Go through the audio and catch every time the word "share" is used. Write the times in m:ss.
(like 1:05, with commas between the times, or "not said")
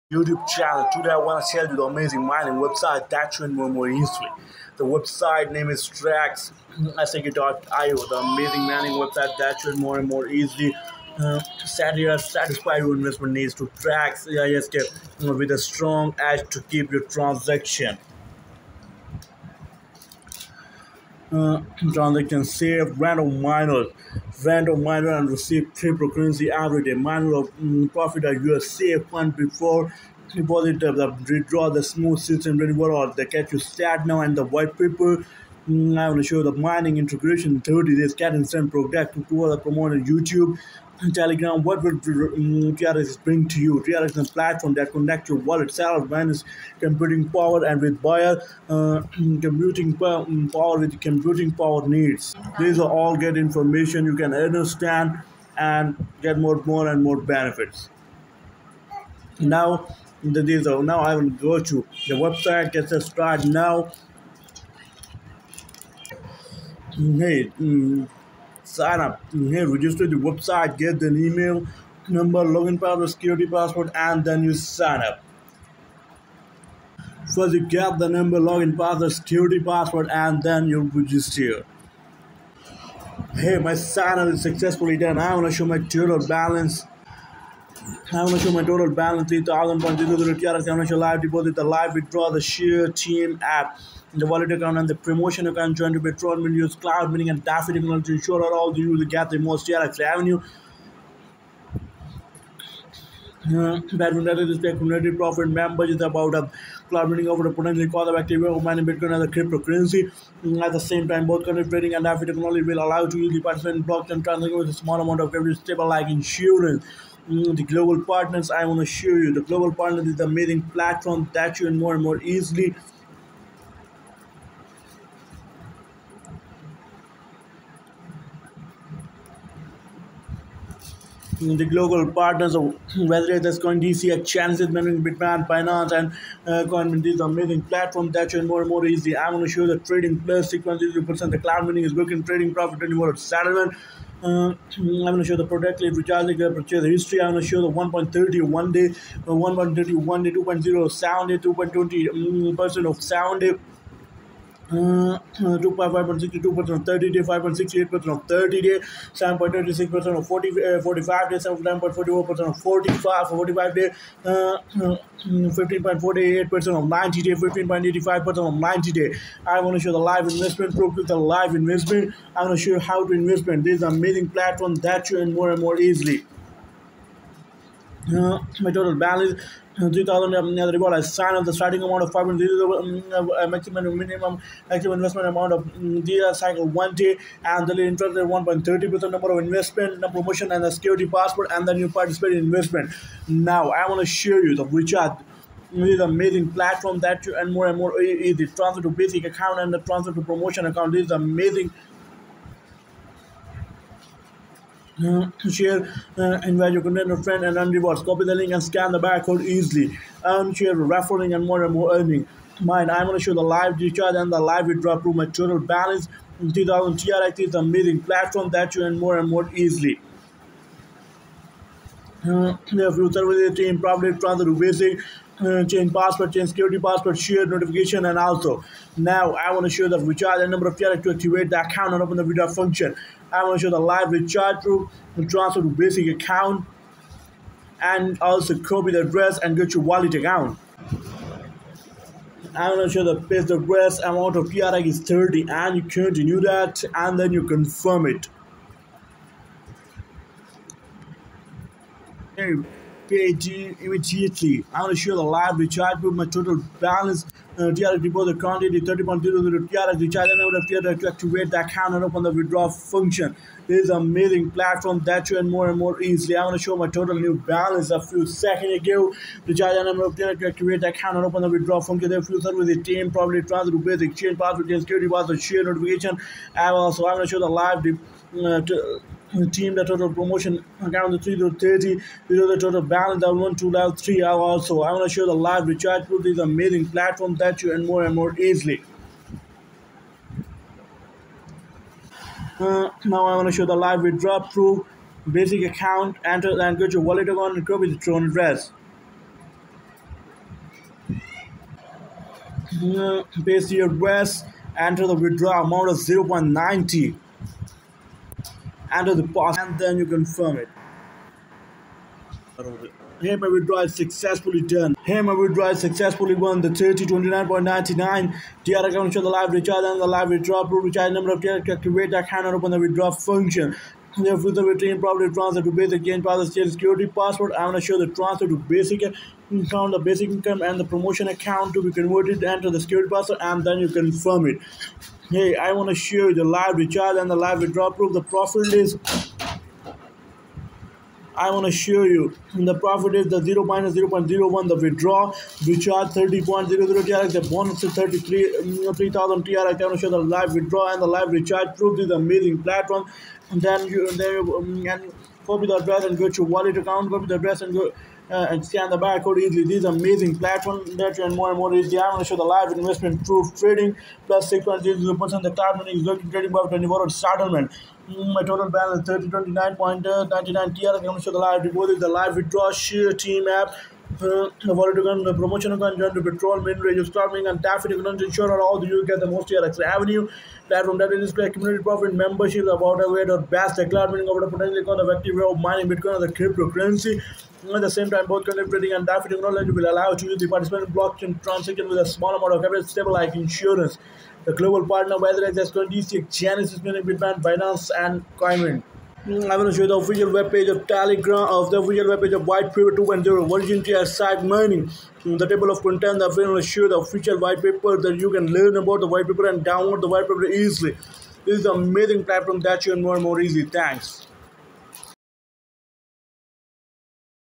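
0:01, 1:32, 3:25, 3:30, 3:47, 4:35, 5:35, 6:12.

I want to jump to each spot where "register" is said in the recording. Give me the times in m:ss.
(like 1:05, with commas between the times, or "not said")
1:09, 1:20.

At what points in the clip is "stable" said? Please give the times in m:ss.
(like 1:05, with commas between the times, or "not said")
1:55, 6:32.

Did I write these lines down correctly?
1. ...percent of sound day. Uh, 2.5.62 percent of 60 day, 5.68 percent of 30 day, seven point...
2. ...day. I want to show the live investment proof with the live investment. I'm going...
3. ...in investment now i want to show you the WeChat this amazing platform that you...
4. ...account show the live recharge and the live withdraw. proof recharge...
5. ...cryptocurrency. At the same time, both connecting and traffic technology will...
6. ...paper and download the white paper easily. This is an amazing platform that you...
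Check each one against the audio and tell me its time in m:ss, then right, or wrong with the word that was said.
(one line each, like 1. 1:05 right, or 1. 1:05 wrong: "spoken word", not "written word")
1. 2:32 wrong: "30", not "60"
2. 2:48 right
3. 3:12 right
4. 5:18 right
5. 6:26 right
6. 6:49 right.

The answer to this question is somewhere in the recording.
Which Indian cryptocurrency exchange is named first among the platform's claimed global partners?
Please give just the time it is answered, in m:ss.
2:13.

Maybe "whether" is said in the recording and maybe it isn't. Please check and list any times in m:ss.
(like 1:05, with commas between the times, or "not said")
2:13, 6:35.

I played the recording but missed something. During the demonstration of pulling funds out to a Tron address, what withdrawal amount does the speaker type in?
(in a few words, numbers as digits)
0.90.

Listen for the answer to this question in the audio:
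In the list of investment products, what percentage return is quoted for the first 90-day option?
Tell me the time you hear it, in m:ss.
2:45.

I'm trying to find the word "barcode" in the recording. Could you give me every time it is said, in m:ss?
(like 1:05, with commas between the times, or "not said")
3:28, 5:58.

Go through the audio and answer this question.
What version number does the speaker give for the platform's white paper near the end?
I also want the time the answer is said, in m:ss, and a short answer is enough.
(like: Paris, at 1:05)
2.0, at 6:42.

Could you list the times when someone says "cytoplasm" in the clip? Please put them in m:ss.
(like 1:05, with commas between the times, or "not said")
not said.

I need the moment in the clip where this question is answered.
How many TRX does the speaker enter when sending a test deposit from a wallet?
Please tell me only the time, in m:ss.
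4:03.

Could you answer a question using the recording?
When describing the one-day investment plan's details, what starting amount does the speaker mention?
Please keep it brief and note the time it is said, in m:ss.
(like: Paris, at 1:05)
500, at 3:02.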